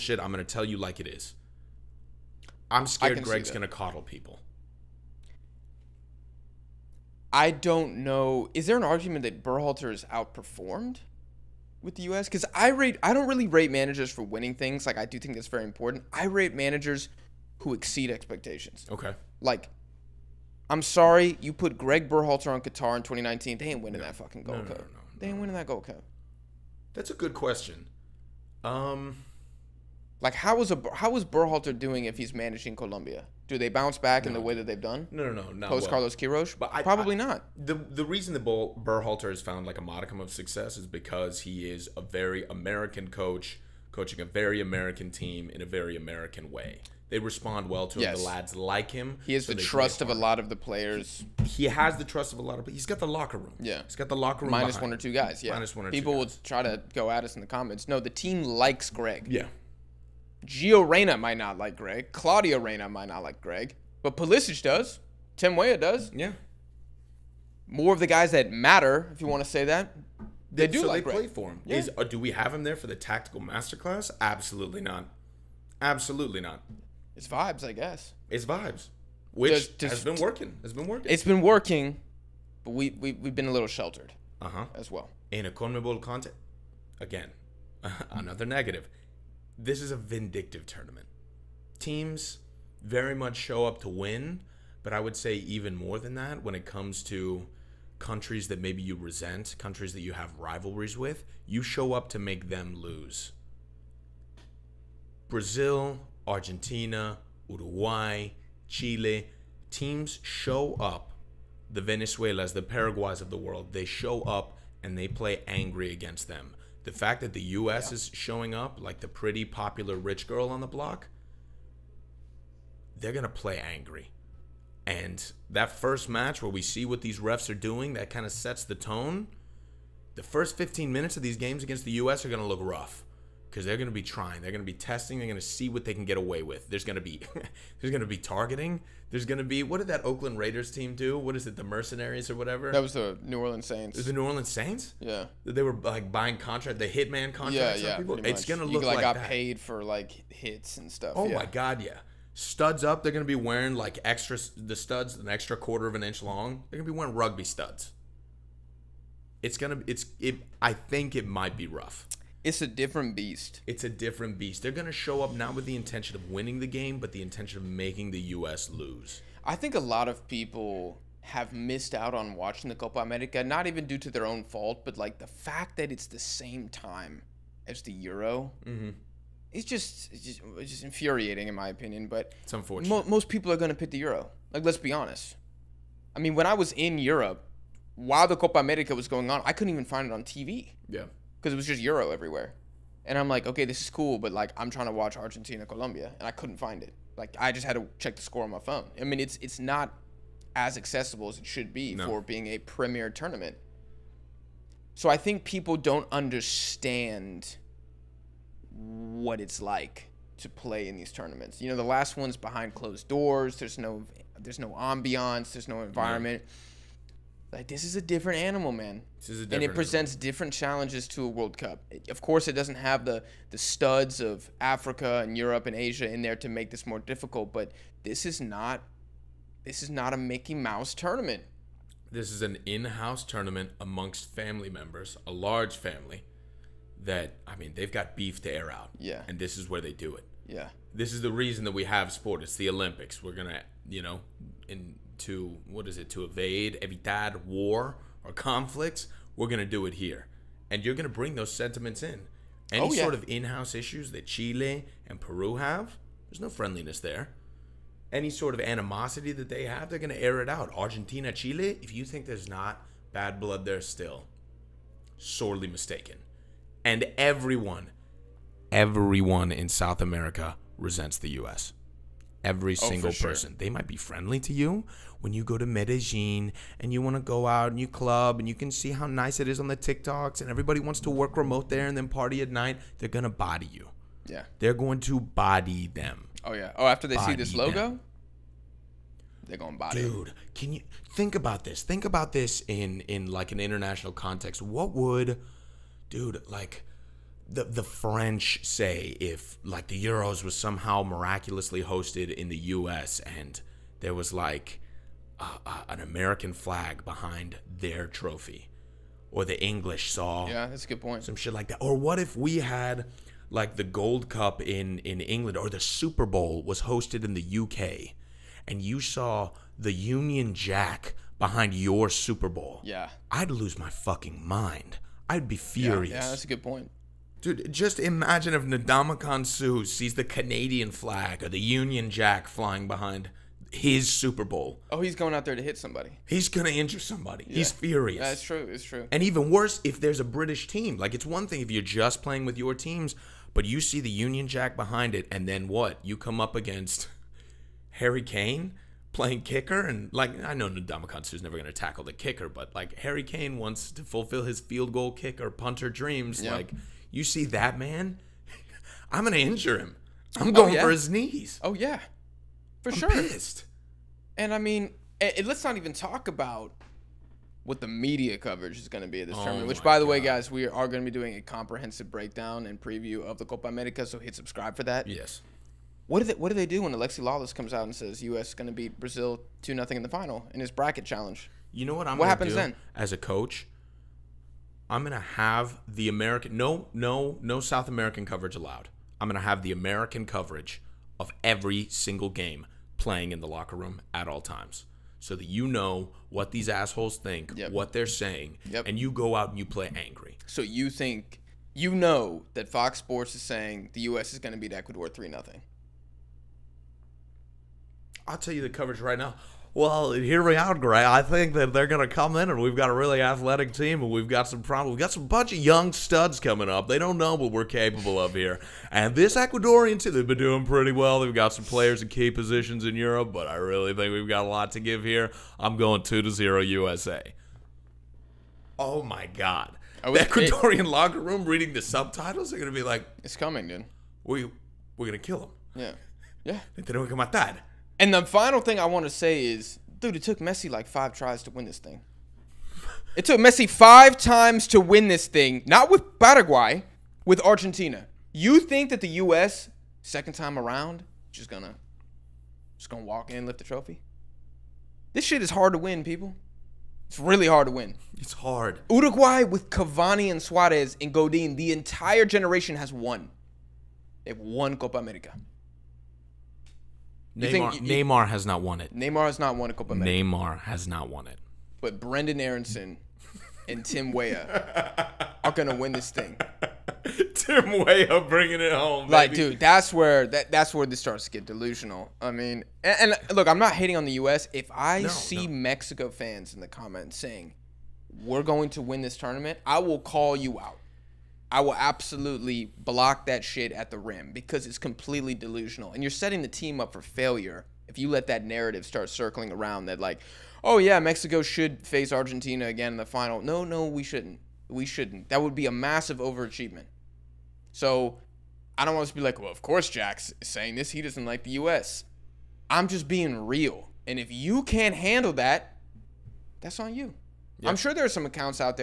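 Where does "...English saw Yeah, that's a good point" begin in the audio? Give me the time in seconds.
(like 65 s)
309 s.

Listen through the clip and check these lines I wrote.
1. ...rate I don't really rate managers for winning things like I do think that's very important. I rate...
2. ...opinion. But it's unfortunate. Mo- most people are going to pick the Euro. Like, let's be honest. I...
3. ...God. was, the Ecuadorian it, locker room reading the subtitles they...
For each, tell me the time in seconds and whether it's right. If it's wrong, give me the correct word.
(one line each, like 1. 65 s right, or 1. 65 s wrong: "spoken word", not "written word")
1. 12 s right
2. 181 s right
3. 429 s right.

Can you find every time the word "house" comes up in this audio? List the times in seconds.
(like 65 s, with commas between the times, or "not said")
232 s, 253 s.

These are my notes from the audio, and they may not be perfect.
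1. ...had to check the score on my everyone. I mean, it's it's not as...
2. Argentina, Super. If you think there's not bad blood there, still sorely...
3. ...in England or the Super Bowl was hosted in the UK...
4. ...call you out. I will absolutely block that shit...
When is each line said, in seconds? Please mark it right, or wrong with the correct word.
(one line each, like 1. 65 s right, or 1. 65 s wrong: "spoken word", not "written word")
1. 197 s wrong: "phone", not "everyone"
2. 260 s wrong: "Chile", not "Super"
3. 314 s right
4. 489 s right.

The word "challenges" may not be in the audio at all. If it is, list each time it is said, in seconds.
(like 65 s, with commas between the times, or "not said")
220 s, 381 s.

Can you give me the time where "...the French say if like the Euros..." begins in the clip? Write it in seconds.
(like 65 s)
297 s.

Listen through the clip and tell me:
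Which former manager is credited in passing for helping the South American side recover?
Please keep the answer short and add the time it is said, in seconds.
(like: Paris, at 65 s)
Carlos Queiroz, at 35 s.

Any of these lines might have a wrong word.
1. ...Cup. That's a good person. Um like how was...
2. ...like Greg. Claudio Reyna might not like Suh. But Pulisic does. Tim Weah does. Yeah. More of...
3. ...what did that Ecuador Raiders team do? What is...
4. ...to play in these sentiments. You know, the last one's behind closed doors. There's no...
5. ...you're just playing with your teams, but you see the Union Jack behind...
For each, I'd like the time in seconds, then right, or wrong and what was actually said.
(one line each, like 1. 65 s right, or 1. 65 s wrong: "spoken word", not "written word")
1. 25 s wrong: "question", not "person"
2. 61 s wrong: "Greg", not "Suh"
3. 139 s wrong: "Oakland", not "Ecuador"
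4. 210 s wrong: "tournaments", not "sentiments"
5. 341 s right.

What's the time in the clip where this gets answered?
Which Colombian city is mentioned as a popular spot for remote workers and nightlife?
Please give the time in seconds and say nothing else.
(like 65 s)
275 s.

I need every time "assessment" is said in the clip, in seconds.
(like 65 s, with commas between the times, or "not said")
not said.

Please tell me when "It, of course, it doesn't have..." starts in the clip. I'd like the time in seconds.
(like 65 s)
221 s.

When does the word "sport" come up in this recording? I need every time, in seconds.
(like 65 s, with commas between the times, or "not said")
242 s, 402 s.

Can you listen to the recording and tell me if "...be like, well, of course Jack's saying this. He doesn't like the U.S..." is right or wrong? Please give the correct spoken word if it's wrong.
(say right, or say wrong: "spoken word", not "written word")
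right.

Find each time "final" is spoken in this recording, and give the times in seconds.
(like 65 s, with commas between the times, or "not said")
380 s, 438 s, 503 s.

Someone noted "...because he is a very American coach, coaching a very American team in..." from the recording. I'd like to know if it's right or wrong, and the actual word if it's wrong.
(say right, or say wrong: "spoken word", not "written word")
right.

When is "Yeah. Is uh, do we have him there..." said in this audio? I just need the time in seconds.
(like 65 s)
71 s.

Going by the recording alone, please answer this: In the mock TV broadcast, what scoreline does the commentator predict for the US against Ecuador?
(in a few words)
2-0 USA.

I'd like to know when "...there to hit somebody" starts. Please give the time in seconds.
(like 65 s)
335 s.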